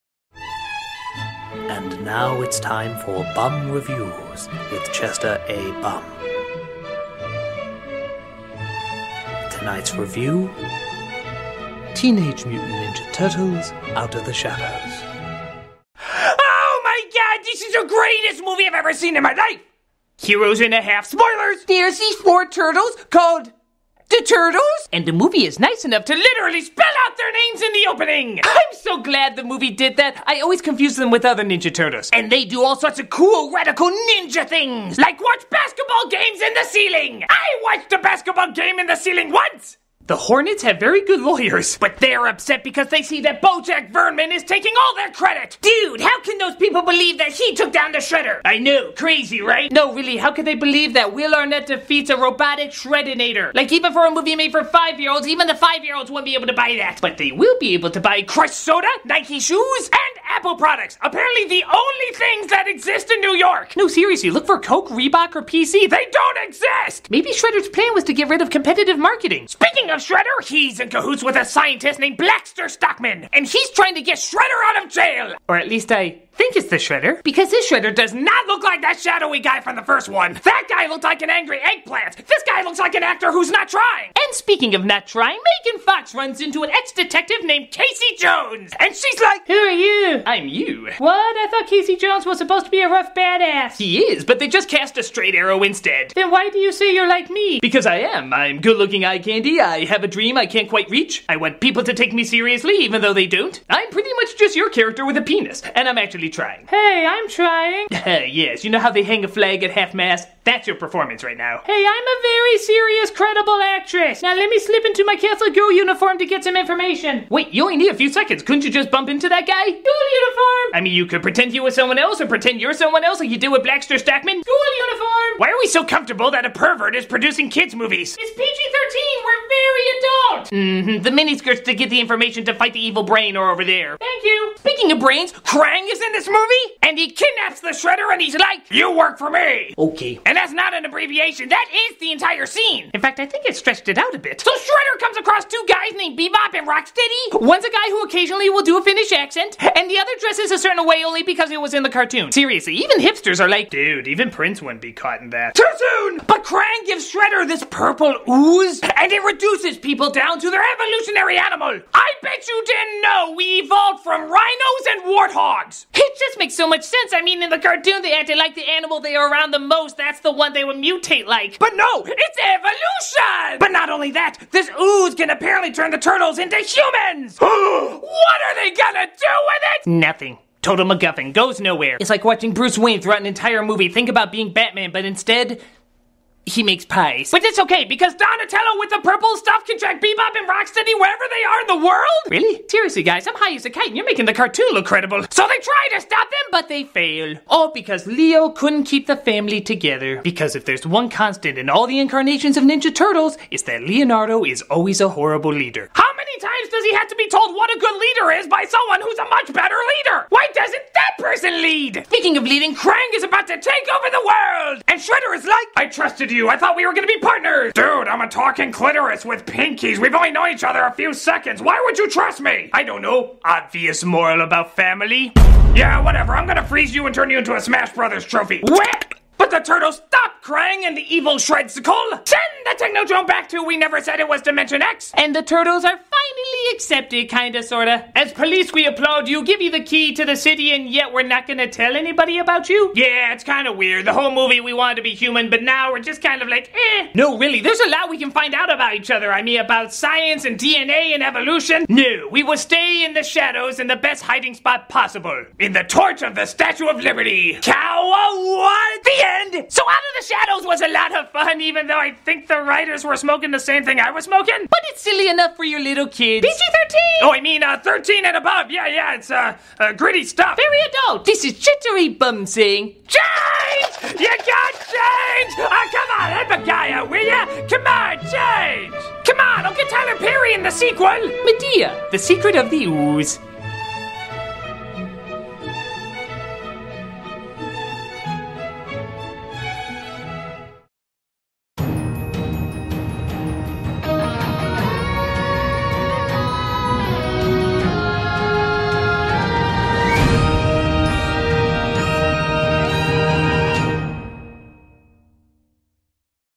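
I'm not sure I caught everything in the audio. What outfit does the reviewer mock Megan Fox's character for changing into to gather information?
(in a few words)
Catholic girl uniform.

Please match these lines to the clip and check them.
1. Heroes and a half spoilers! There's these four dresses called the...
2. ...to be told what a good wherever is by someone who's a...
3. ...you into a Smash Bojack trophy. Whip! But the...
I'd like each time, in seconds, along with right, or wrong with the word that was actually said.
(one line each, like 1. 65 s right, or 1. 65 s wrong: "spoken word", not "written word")
1. 20 s wrong: "turtles", not "dresses"
2. 207 s wrong: "leader", not "wherever"
3. 227 s wrong: "Brothers", not "Bojack".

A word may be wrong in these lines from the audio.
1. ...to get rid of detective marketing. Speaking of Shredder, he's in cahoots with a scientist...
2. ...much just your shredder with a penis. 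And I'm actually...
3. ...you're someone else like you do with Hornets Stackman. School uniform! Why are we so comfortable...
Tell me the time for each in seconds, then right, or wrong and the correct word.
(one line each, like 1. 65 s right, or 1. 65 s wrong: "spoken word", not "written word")
1. 68 s wrong: "competitive", not "detective"
2. 104 s wrong: "character", not "shredder"
3. 122 s wrong: "Blackster", not "Hornets".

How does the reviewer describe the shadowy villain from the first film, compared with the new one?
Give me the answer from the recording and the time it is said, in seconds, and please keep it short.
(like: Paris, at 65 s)
An angry eggplant, at 81 s.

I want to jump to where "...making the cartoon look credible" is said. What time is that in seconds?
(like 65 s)
194 s.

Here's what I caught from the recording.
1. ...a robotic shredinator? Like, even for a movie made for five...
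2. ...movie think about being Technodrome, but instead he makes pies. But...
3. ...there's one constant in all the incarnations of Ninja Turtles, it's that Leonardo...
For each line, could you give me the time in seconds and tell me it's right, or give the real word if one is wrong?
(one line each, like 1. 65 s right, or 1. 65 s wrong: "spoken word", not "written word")
1. 52 s right
2. 183 s wrong: "Batman", not "Technodrome"
3. 200 s right.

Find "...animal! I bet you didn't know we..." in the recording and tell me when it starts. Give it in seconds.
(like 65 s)
161 s.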